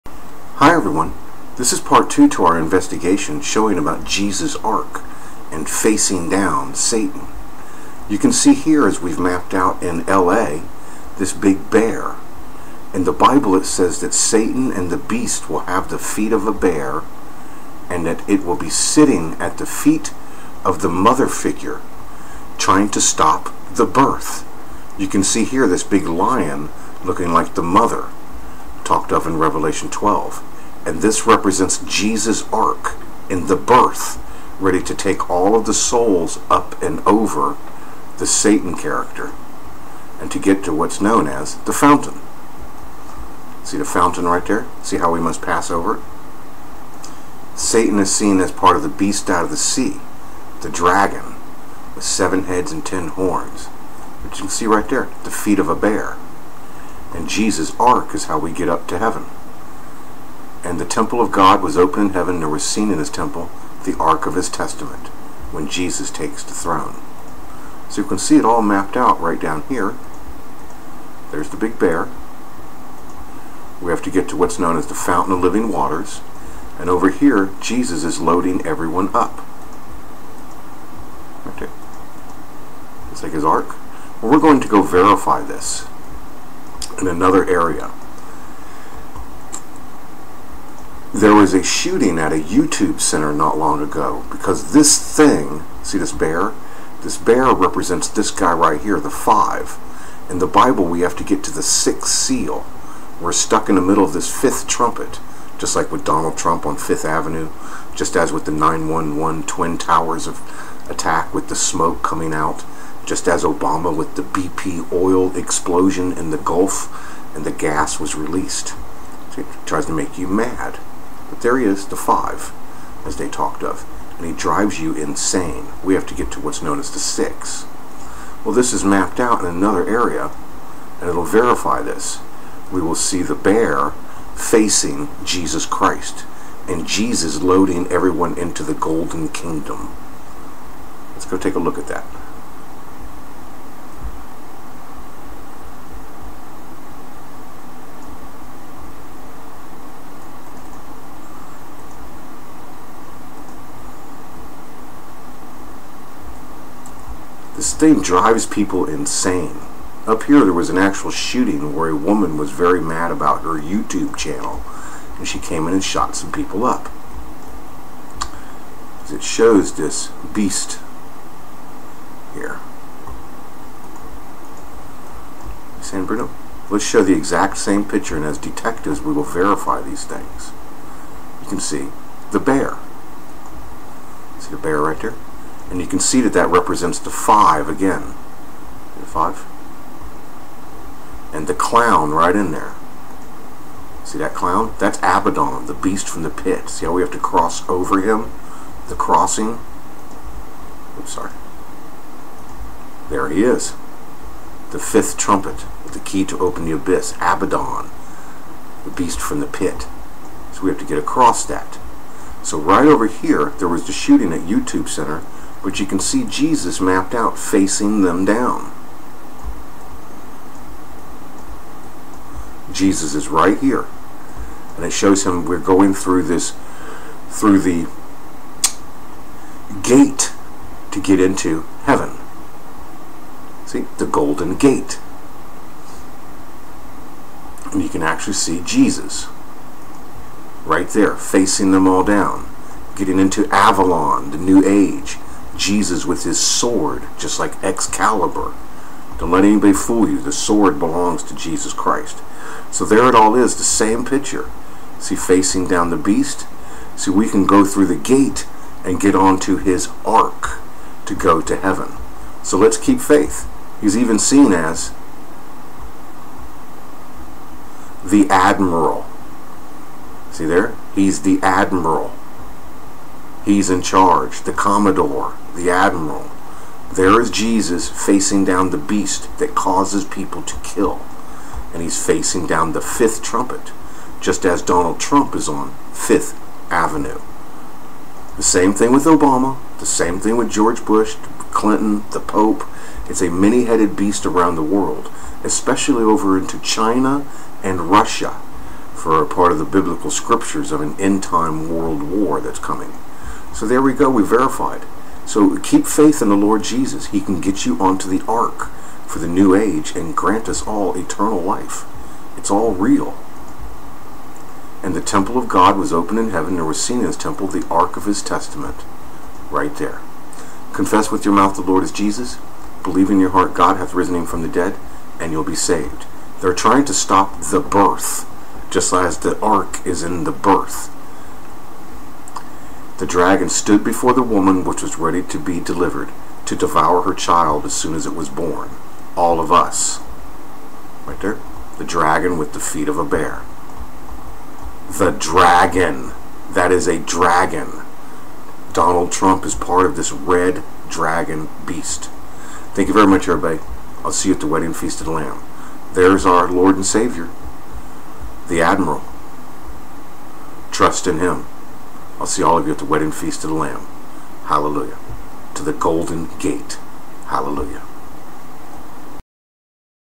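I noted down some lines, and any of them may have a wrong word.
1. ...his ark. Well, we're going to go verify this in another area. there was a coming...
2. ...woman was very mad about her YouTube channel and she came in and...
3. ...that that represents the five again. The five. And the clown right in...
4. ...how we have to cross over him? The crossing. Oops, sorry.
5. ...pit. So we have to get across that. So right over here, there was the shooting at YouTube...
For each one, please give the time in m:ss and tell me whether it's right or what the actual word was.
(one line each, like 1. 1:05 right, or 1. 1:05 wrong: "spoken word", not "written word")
1. 1:23 wrong: "shooting", not "coming"
2. 2:41 right
3. 3:06 right
4. 3:16 right
5. 3:29 right.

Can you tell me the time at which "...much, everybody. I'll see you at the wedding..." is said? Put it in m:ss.
5:53.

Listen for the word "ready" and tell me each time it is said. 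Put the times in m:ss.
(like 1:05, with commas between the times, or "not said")
0:34, 5:34.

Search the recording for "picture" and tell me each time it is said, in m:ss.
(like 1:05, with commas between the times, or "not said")
2:57, 4:14.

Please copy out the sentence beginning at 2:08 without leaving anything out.
Well, this is mapped out in another area, and it'll verify this.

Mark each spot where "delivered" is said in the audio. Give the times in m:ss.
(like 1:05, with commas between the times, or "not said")
5:35.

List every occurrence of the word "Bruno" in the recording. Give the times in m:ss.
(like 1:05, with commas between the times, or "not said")
2:56.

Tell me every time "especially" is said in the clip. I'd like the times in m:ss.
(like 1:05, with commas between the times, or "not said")
4:55.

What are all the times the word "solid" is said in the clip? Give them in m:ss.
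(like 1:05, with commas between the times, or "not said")
not said.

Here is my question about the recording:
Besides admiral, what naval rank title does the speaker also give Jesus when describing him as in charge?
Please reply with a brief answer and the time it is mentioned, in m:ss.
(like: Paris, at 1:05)
Commodore, at 4:34.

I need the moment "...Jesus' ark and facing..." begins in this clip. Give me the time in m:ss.
0:04.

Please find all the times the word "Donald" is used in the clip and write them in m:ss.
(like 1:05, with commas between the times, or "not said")
1:46, 4:44, 5:48.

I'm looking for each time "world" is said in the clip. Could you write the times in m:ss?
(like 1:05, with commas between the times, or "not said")
4:54, 5:01.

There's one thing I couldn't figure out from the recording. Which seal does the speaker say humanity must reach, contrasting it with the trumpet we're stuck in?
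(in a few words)
sixth seal.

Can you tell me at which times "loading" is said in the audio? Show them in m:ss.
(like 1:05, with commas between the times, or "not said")
1:18, 2:17.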